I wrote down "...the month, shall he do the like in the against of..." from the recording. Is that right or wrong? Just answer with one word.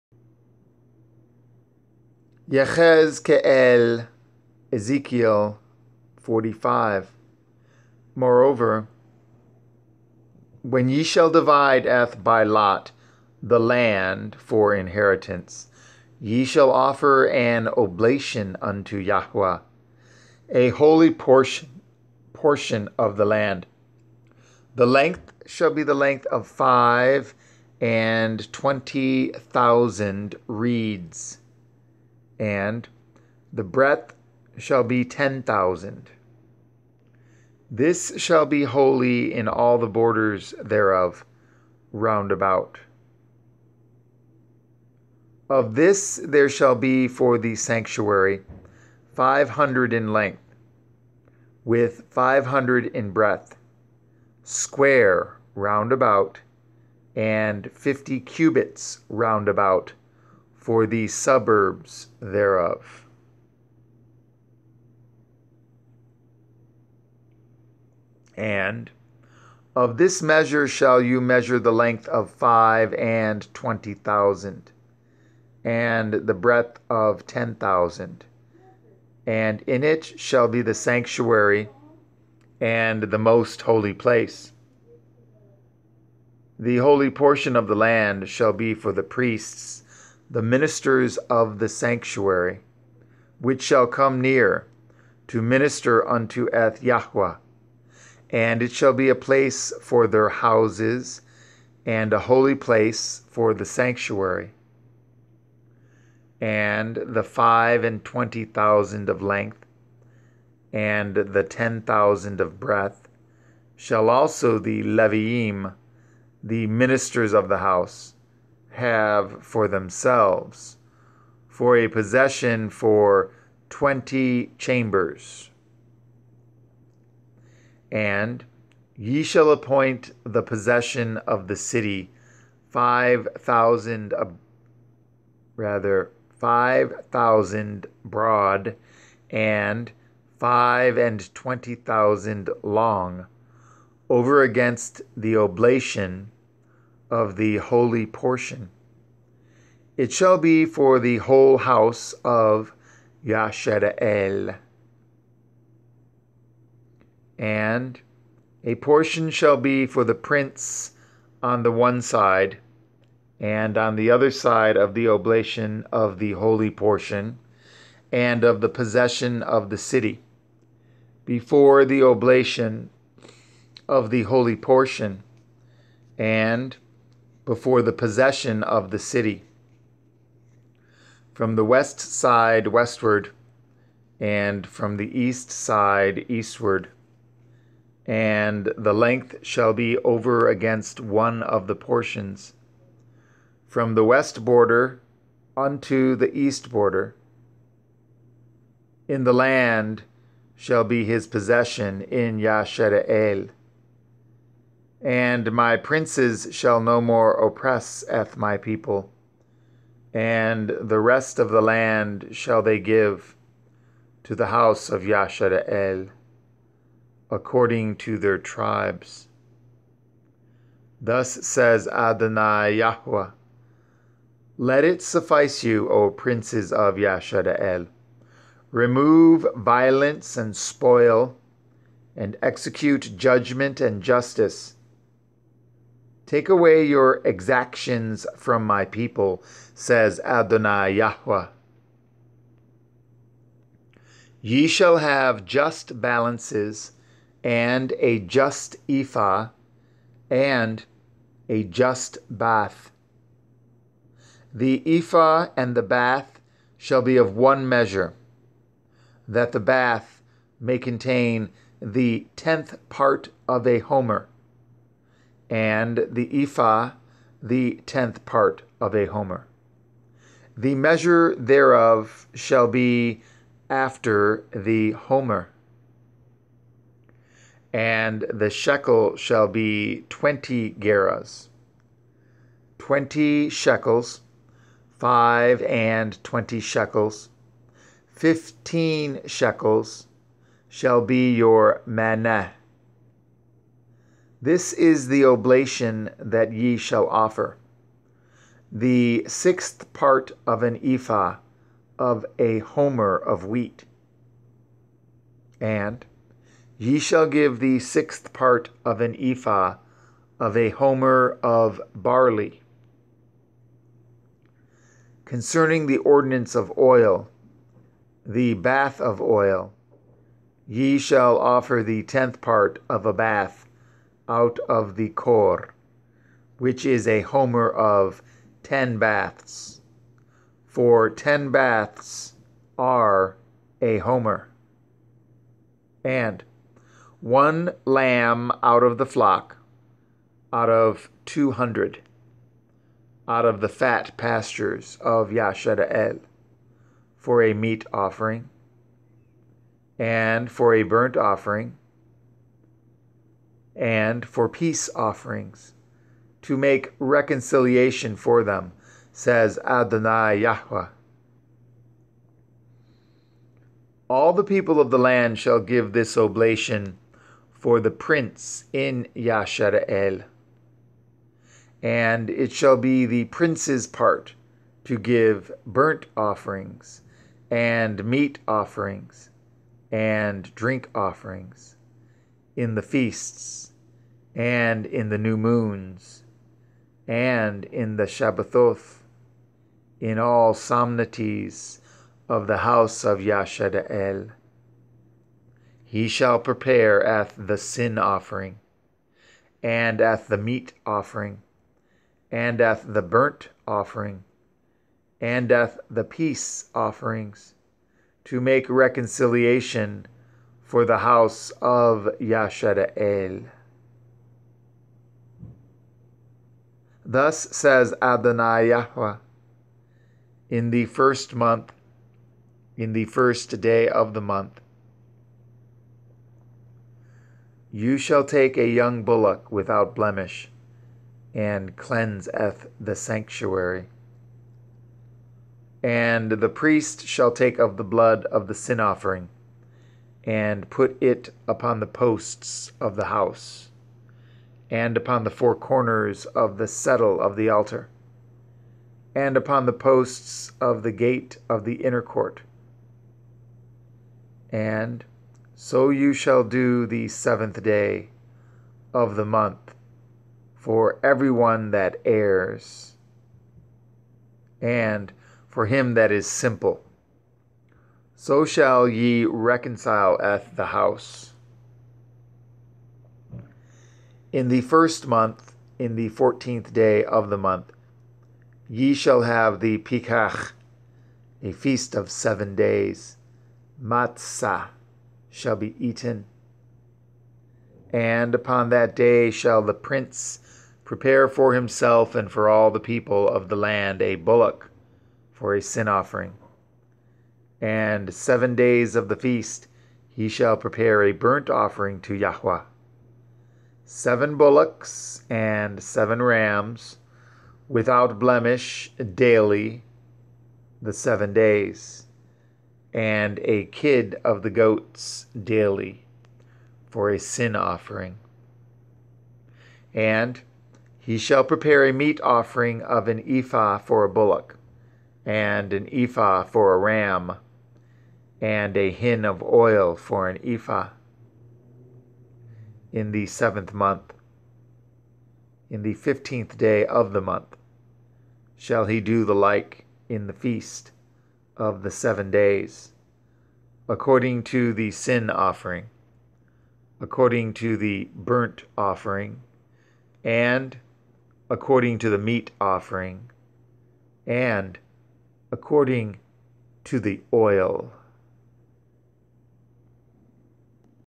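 wrong.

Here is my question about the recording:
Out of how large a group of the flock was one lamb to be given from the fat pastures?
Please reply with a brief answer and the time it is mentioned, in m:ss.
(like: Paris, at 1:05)
200, at 5:41.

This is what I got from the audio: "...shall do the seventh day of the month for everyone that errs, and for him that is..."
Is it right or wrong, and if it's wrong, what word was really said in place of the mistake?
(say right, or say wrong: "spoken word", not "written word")
right.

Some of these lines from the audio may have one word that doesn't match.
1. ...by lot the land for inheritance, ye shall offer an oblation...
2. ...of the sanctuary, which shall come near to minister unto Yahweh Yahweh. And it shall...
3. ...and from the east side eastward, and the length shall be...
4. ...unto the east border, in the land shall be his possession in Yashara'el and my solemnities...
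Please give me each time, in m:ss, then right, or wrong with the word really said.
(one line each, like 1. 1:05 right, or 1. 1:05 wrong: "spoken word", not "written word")
1. 0:12 right
2. 1:31 wrong: "Eth", not "Yahweh"
3. 3:04 right
4. 3:15 wrong: "princes", not "solemnities".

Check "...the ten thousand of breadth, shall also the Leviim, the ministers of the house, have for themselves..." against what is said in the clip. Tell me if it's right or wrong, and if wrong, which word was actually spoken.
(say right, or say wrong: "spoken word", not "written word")
right.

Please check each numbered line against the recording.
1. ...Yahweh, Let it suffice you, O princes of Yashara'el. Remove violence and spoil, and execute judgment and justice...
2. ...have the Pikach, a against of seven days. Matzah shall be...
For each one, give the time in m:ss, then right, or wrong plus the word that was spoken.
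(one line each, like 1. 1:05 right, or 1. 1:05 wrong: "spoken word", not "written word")
1. 3:42 right
2. 7:59 wrong: "feast", not "against".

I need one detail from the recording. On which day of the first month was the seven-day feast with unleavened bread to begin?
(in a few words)
14th.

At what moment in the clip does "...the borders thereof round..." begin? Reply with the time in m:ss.
0:39.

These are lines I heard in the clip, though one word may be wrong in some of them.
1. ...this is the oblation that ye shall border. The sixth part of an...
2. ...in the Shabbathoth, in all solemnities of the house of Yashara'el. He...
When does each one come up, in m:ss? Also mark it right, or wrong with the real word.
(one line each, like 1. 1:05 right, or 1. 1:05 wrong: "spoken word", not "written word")
1. 4:54 wrong: "offer", not "border"
2. 6:27 right.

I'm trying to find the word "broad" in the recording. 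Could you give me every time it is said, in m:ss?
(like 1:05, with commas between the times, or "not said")
2:18.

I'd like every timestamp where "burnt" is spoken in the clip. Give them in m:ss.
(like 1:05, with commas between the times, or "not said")
5:50, 6:15, 6:43, 8:21, 9:08.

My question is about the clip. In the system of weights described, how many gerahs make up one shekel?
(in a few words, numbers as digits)
20.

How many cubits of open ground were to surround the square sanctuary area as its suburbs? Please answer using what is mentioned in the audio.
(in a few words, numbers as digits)
50.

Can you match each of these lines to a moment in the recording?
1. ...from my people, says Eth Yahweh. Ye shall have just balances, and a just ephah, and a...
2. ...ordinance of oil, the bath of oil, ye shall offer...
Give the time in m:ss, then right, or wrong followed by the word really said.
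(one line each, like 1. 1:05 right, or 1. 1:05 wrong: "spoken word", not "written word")
1. 3:58 wrong: "Adonai", not "Eth"
2. 5:15 right.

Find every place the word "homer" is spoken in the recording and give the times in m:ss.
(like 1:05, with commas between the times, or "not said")
4:23, 4:29, 4:34, 5:02, 5:10, 5:27, 5:33.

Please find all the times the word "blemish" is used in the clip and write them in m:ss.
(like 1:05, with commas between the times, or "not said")
7:09, 8:28.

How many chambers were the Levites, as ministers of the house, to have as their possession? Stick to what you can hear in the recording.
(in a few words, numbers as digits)
20.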